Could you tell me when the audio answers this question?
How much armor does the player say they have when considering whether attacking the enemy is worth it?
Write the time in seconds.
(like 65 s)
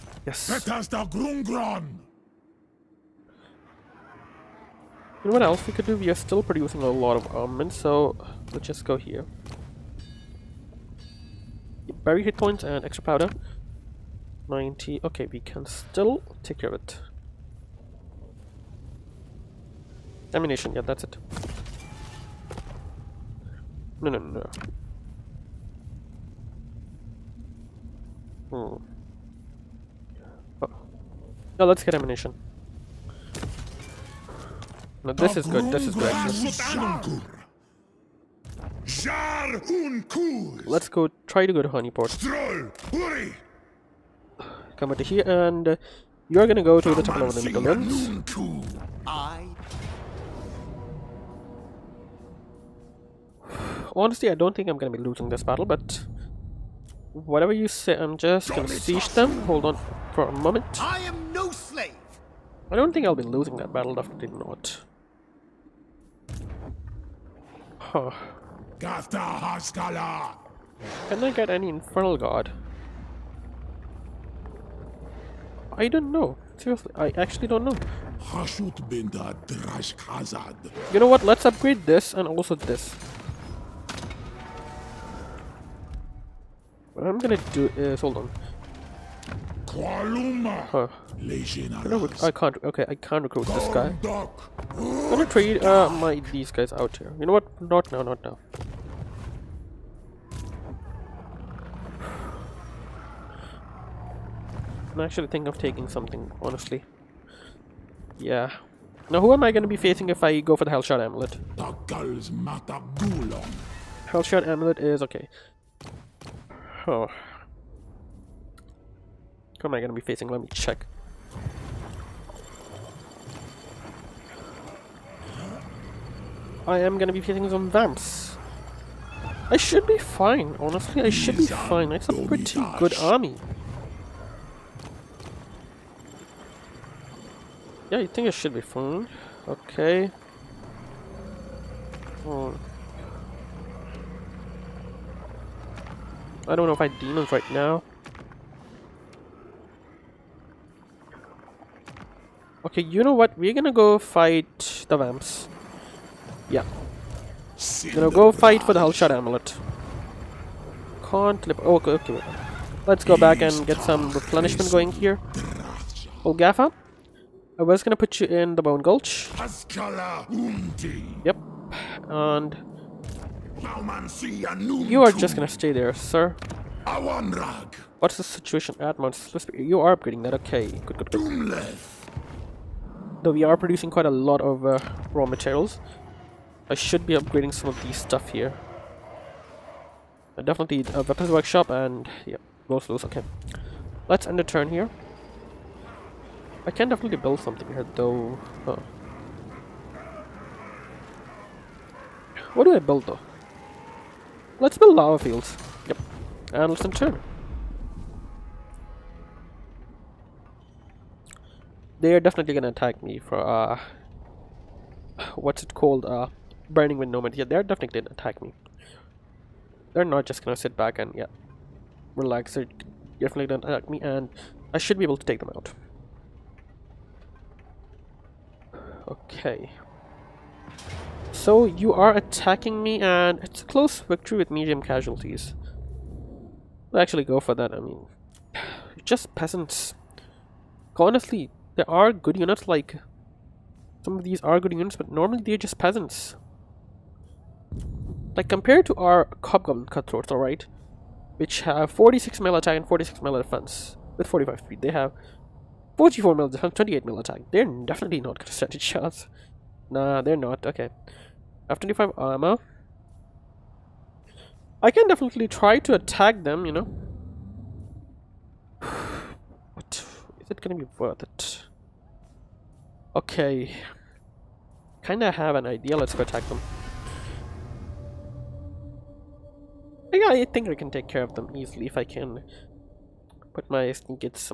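261 s.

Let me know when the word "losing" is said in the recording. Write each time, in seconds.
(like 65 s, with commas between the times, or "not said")
54 s, 63 s.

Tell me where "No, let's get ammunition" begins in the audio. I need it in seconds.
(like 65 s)
31 s.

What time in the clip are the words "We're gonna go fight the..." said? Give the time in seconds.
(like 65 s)
153 s.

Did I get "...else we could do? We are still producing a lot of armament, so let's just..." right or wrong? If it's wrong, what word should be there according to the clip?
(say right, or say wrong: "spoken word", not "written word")
right.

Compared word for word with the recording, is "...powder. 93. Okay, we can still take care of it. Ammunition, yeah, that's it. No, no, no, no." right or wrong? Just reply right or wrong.
wrong.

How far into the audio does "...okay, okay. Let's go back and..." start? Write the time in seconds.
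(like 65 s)
161 s.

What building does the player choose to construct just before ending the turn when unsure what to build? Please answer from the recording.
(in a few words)
Lava fields.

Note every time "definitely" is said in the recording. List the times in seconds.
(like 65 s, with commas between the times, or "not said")
63 s, 190 s, 196 s, 212 s, 217 s, 223 s, 257 s, 265 s.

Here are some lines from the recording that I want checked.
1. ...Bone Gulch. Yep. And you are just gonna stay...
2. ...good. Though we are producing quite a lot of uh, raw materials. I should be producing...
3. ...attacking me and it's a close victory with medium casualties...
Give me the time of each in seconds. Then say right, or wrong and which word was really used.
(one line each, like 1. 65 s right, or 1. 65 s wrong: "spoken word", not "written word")
1. 168 s right
2. 181 s wrong: "upgrading", not "producing"
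3. 232 s right.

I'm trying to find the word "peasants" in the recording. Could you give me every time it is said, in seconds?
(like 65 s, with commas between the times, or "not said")
239 s, 245 s.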